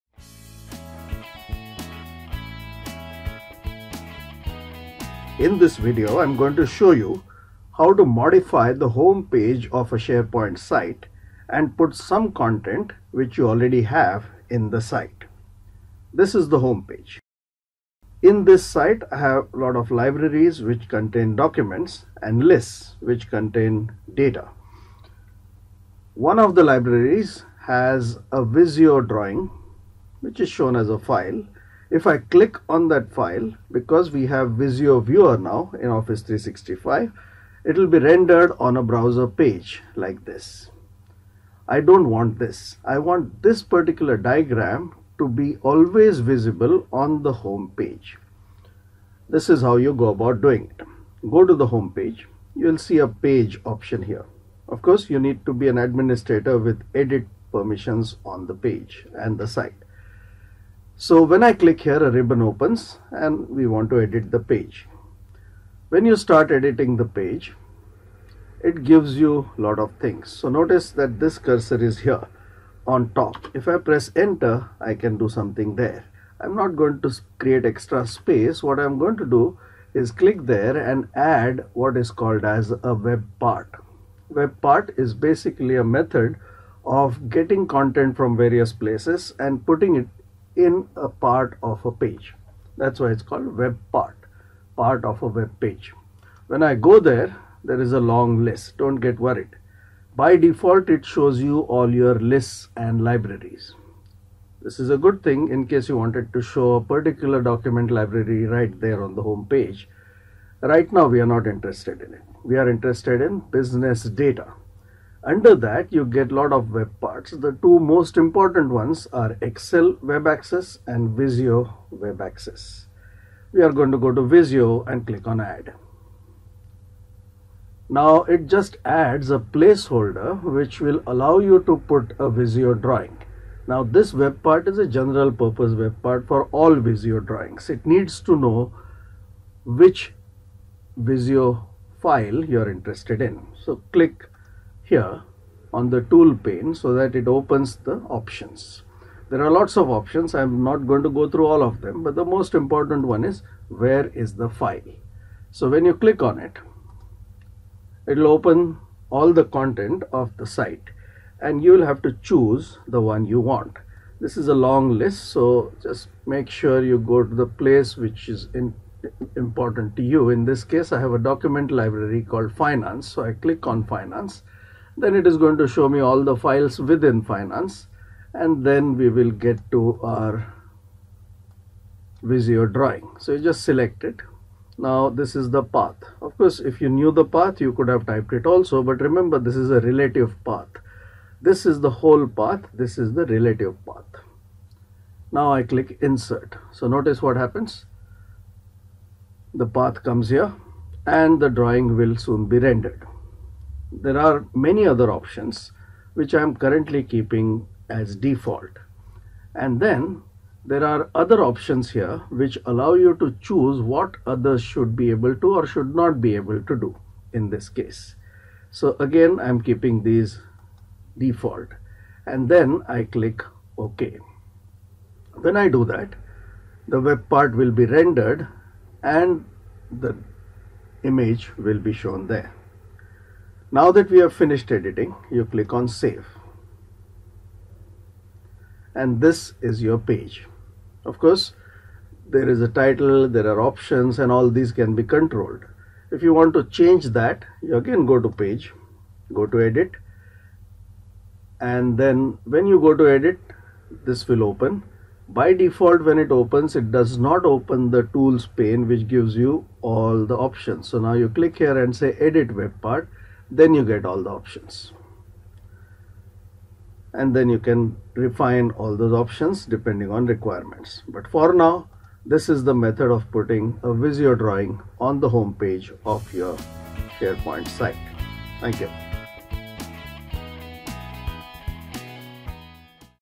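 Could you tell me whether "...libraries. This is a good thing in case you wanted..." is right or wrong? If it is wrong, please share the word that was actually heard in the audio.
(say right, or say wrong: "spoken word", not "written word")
right.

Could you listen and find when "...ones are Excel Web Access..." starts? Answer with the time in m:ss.
1:58.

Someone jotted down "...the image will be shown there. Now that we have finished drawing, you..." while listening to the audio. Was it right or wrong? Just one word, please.
wrong.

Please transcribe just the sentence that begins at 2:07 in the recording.
Now it just adds a placeholder which will allow you to put a Visio drawing.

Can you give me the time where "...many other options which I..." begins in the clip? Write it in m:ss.
3:24.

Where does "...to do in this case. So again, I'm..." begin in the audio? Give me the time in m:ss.
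3:36.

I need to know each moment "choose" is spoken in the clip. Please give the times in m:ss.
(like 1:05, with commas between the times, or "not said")
2:42, 3:33.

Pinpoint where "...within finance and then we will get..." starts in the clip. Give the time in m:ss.
2:56.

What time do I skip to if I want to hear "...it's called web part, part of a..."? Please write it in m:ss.
1:33.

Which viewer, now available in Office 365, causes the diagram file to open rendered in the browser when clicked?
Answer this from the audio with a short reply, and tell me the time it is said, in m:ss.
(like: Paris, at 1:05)
Visio Viewer, at 0:34.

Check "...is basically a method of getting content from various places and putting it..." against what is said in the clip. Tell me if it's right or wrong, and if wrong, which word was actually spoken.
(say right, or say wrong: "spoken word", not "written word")
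right.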